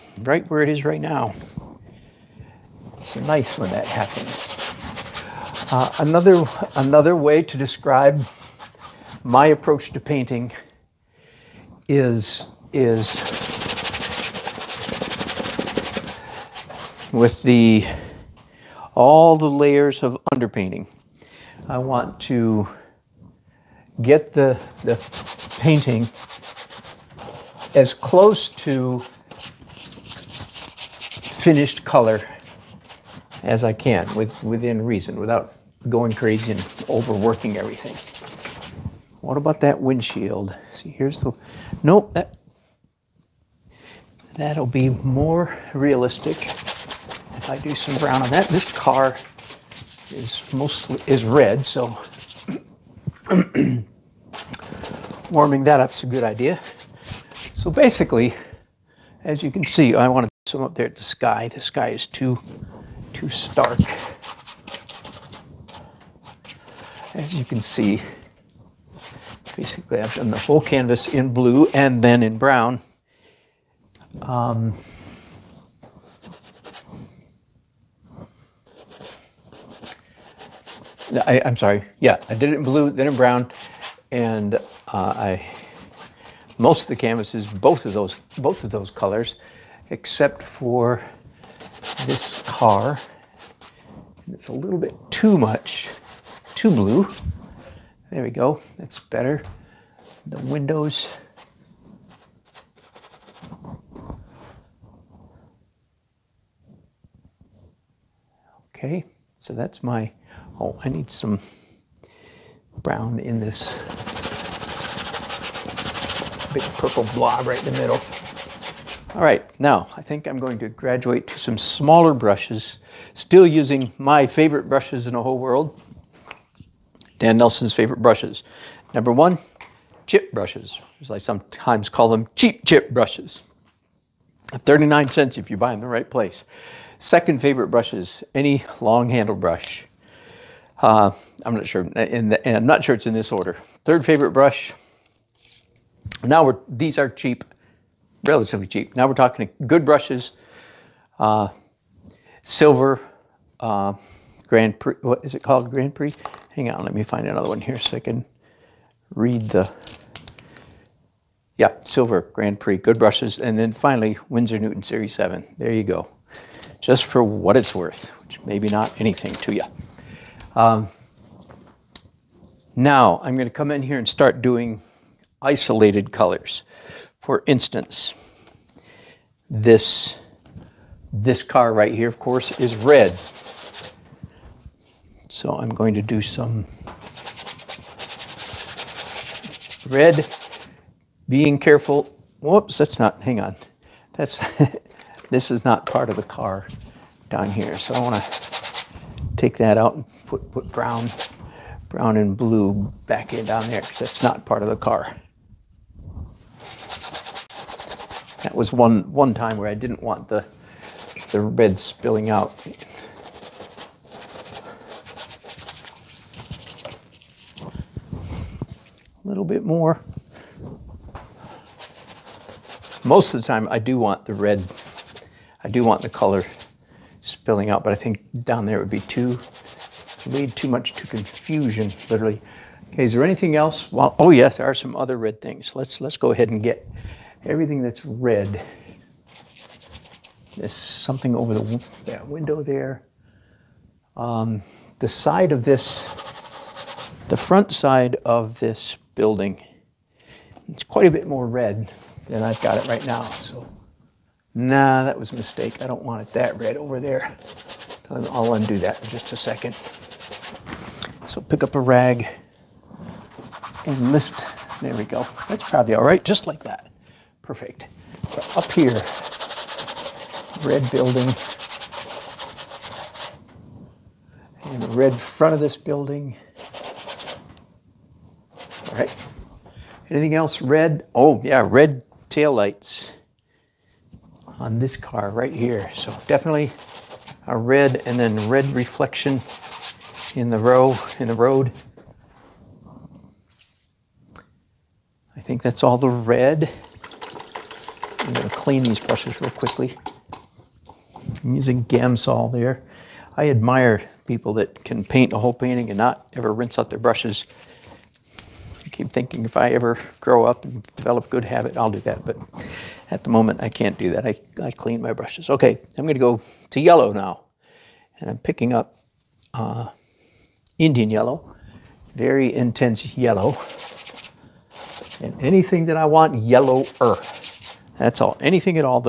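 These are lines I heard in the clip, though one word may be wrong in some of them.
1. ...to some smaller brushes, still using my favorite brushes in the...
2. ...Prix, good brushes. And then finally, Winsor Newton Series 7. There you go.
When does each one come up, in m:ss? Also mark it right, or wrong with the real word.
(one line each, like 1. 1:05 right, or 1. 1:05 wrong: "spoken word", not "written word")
1. 2:01 right
2. 2:42 right.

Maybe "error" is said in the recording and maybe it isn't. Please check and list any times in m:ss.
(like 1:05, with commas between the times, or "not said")
not said.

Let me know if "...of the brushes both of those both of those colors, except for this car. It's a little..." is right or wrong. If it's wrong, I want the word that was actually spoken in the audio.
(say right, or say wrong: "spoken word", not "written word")
wrong: "canvases", not "brushes".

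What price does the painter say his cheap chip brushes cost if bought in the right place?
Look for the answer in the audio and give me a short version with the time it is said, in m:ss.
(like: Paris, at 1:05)
39 cents, at 2:14.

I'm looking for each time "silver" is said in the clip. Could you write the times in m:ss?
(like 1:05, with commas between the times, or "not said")
2:32, 2:41.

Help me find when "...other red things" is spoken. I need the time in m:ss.
3:54.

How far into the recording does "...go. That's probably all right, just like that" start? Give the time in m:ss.
4:25.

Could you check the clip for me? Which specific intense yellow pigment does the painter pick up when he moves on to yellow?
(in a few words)
Indian yellow.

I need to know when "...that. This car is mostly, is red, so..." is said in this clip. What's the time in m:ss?
0:48.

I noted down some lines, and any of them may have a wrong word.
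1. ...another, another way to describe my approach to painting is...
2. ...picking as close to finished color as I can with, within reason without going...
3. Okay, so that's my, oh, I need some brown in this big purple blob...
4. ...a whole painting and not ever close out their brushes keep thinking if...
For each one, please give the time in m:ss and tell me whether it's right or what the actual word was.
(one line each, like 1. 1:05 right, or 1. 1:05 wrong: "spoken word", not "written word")
1. 0:05 right
2. 0:25 wrong: "painting", not "picking"
3. 1:48 right
4. 5:05 wrong: "rinse", not "close".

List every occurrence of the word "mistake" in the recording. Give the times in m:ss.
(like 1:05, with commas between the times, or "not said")
4:15.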